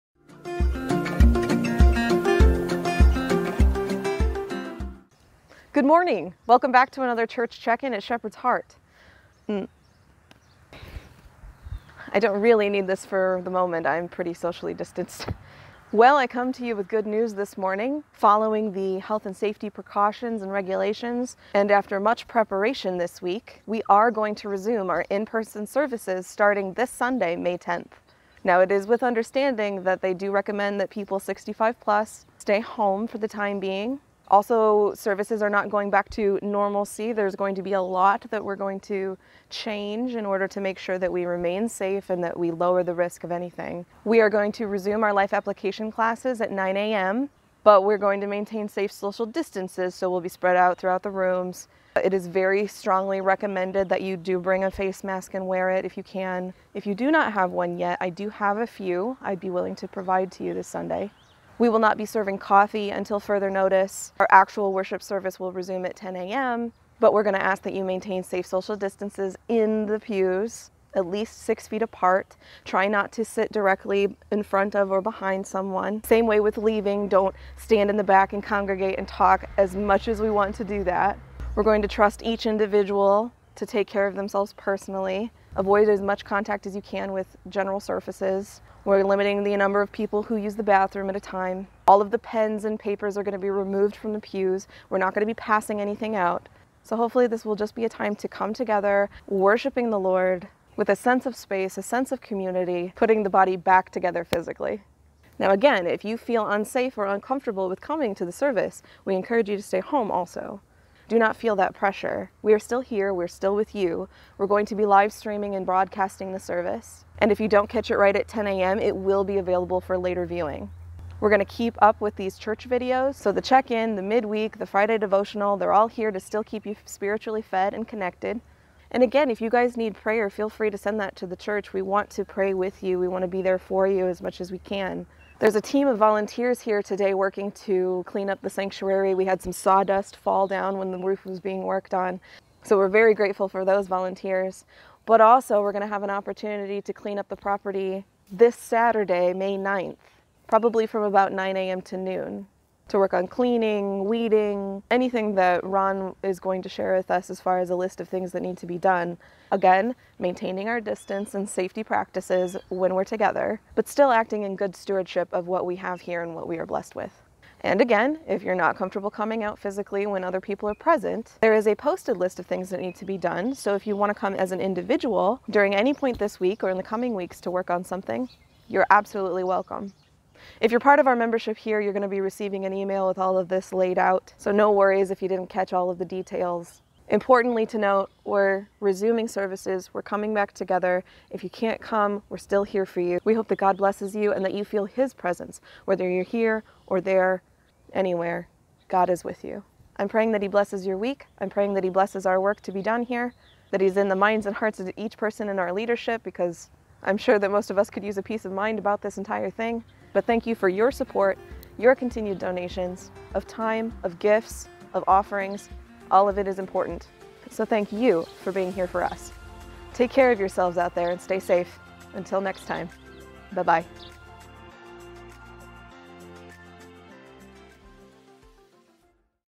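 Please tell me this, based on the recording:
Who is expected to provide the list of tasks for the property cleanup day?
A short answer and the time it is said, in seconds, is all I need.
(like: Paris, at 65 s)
Ron, at 155 s.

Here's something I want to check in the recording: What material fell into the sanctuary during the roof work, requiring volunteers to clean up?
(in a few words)
Sawdust.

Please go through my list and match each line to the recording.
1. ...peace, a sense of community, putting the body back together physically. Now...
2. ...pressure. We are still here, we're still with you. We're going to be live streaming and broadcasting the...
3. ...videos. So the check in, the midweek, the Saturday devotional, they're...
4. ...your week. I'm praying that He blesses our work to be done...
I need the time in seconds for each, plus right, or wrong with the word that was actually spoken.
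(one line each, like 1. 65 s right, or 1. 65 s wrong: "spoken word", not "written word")
1. 101 s wrong: "space", not "peace"
2. 111 s right
3. 122 s wrong: "Friday", not "Saturday"
4. 200 s right.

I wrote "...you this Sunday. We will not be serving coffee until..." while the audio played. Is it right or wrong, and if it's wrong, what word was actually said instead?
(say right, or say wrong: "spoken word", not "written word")
right.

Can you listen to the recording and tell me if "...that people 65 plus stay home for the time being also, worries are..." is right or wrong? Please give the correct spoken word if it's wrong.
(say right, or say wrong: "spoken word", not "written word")
wrong: "services", not "worries".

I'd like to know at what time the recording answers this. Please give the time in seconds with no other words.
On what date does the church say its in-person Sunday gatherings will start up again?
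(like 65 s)
27 s.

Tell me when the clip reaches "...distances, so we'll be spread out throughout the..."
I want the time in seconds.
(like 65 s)
49 s.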